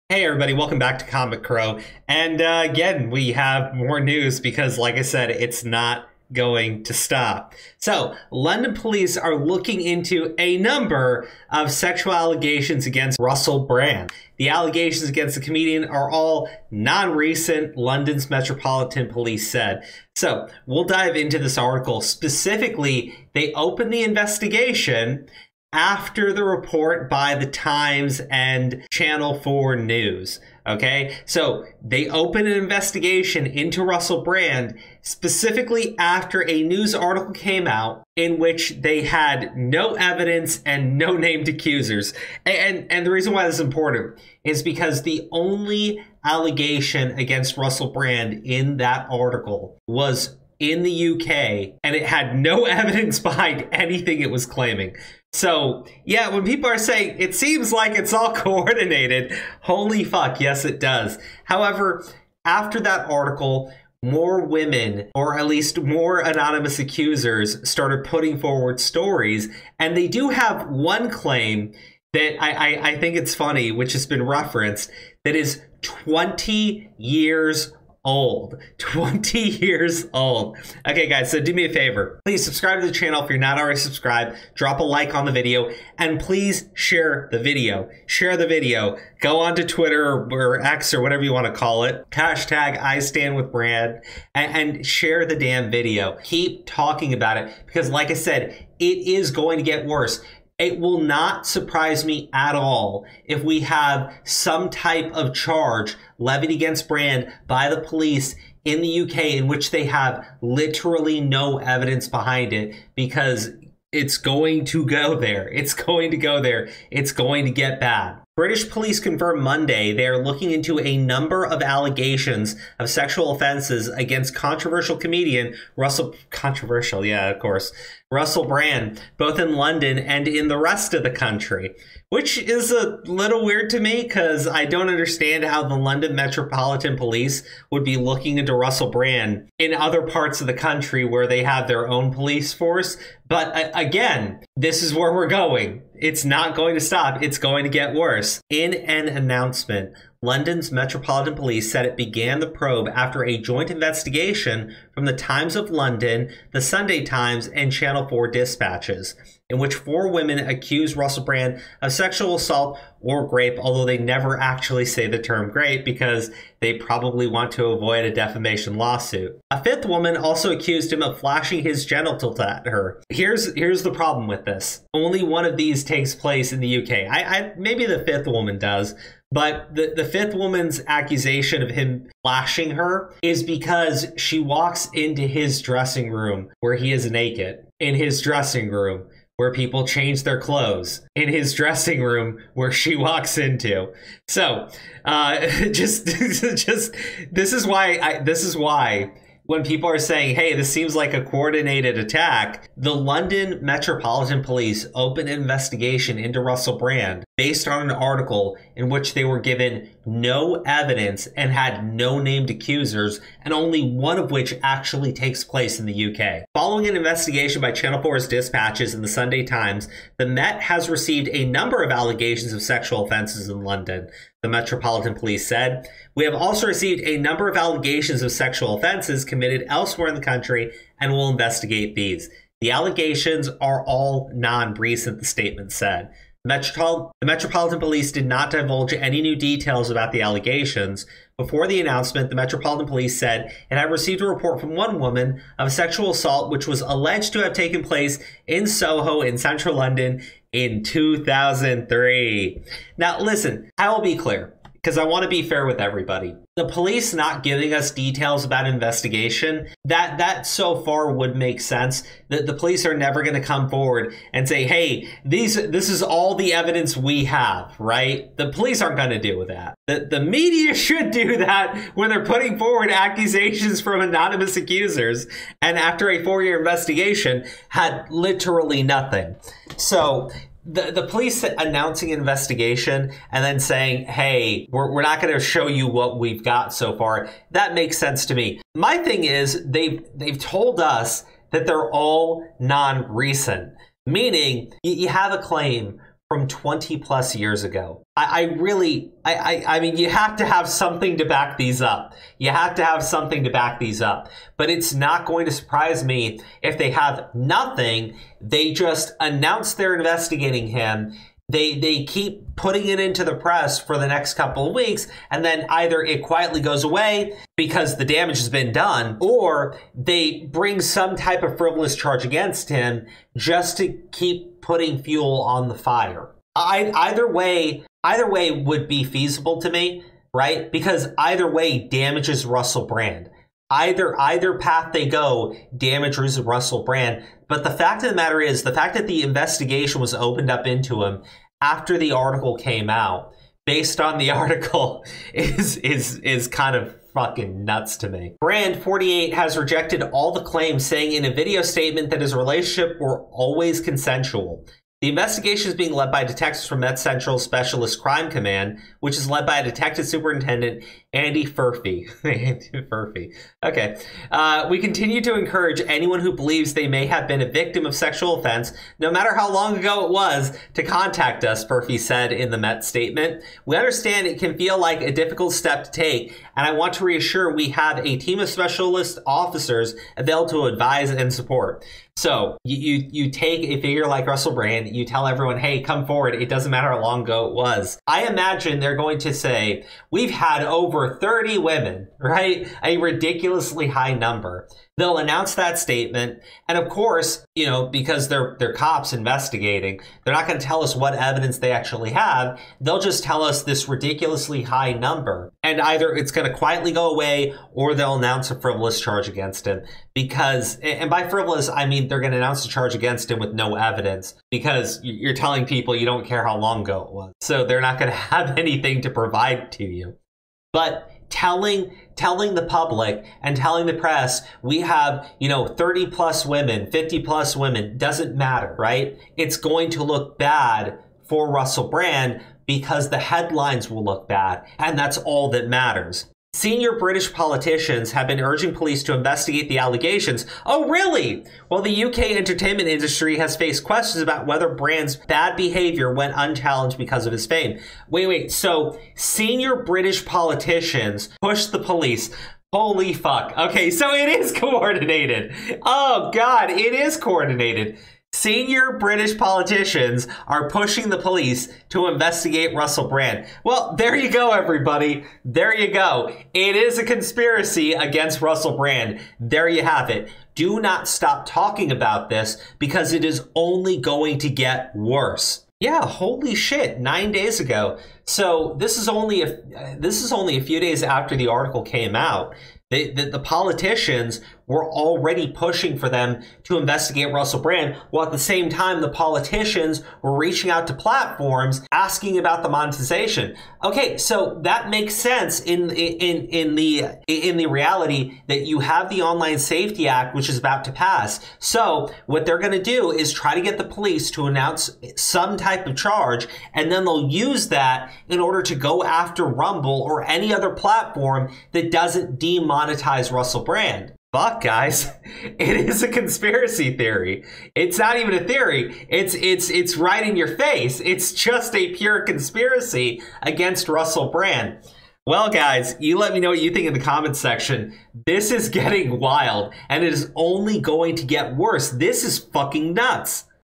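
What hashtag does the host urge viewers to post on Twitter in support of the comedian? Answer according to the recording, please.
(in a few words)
I stand with Brand.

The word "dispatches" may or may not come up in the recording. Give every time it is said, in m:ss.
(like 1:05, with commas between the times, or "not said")
2:38, 3:38.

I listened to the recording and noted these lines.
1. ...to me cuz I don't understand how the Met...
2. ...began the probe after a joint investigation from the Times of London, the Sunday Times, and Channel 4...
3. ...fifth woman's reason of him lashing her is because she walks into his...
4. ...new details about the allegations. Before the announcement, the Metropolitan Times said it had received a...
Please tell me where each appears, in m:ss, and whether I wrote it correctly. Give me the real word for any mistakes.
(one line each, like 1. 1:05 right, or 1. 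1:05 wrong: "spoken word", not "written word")
1. 2:13 wrong: "London", not "Met"
2. 2:31 right
3. 3:00 wrong: "accusation", not "reason"
4. 3:59 wrong: "Police", not "Times".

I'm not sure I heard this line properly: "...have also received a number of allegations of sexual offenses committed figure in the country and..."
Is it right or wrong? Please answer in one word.
wrong.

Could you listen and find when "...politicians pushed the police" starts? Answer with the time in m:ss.
7:30.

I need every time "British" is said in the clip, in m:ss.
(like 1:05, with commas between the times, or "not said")
1:58, 7:16, 7:29, 7:38.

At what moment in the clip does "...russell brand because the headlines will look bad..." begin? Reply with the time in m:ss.
7:11.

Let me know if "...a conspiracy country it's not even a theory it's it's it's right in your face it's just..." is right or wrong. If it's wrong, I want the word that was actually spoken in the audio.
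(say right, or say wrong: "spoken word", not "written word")
wrong: "theory", not "country".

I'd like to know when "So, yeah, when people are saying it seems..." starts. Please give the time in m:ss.
0:55.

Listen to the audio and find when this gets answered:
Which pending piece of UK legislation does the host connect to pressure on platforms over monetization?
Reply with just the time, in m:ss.
8:19.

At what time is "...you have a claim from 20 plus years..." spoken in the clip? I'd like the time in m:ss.
4:54.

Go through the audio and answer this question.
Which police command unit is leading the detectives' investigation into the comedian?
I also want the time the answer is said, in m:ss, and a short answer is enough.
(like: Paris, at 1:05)
Central Specialist Crime Command, at 5:56.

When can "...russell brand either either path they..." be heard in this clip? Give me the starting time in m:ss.
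5:32.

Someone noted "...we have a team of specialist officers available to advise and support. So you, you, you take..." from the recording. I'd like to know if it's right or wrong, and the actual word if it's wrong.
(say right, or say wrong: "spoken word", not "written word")
right.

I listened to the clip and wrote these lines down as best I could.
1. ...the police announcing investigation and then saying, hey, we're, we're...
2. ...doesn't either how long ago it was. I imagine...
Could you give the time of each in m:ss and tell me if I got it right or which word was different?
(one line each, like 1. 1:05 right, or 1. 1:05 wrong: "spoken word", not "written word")
1. 4:40 right
2. 6:26 wrong: "matter", not "either".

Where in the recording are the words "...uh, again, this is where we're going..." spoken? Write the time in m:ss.
2:23.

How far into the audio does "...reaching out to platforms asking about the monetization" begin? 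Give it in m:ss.
8:10.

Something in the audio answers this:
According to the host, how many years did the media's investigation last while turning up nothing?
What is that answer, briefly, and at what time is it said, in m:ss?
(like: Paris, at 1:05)
4, at 4:36.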